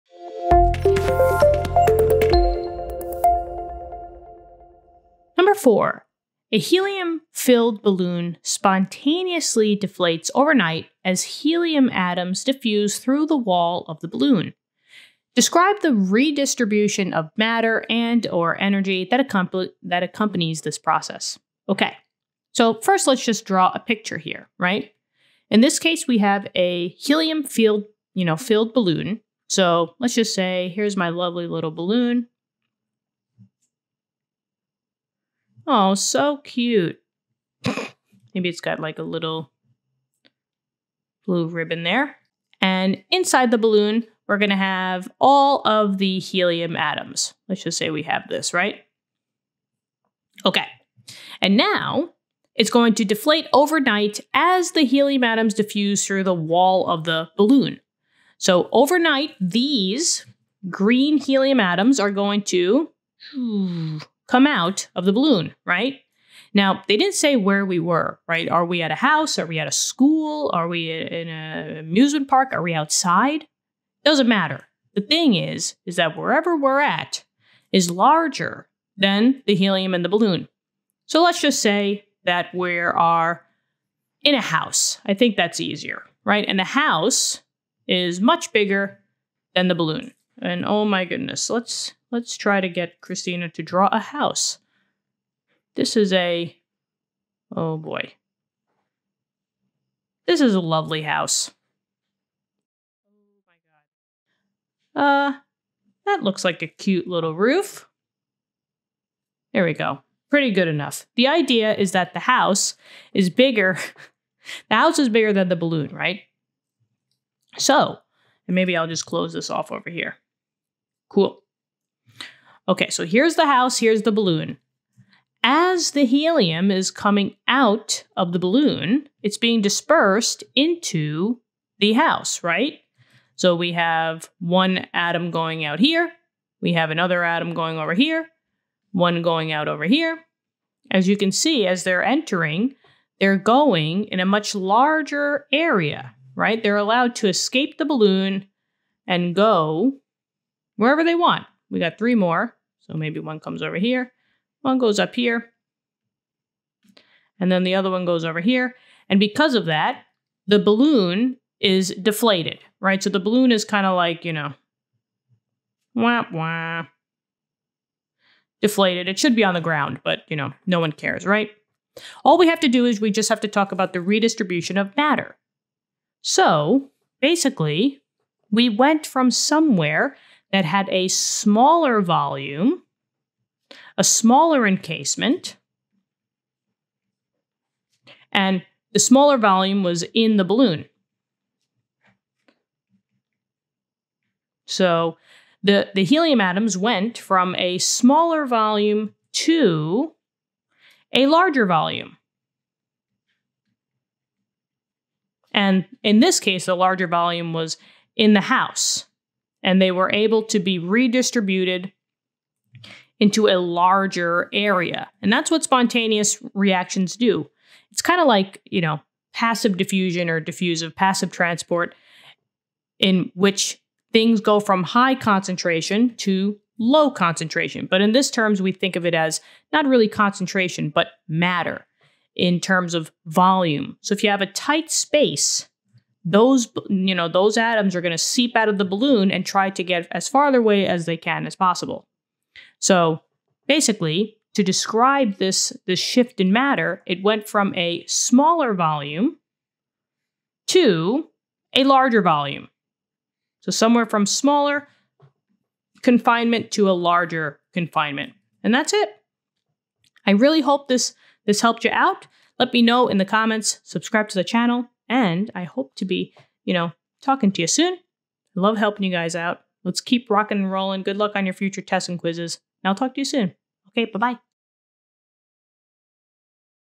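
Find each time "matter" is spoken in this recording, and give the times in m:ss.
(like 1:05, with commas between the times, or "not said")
0:17, 1:14, 2:54, 3:51, 4:06.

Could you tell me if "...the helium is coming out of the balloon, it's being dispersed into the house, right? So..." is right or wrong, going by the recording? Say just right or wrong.
right.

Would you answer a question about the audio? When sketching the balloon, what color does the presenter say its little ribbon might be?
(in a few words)
blue.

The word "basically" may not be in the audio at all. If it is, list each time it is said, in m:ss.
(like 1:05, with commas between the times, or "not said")
2:57, 4:03.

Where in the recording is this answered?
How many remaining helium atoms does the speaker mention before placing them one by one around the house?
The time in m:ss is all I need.
2:31.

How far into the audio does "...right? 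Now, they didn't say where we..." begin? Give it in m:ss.
1:05.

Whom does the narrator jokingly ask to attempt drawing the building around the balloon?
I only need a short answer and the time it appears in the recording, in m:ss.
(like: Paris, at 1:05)
Christina, at 1:33.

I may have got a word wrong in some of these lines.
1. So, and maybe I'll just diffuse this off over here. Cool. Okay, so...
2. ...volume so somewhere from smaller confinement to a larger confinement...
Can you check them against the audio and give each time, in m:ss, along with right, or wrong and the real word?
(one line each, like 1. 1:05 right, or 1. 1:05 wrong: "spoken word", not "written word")
1. 1:57 wrong: "close", not "diffuse"
2. 4:12 right.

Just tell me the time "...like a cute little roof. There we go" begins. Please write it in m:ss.
1:46.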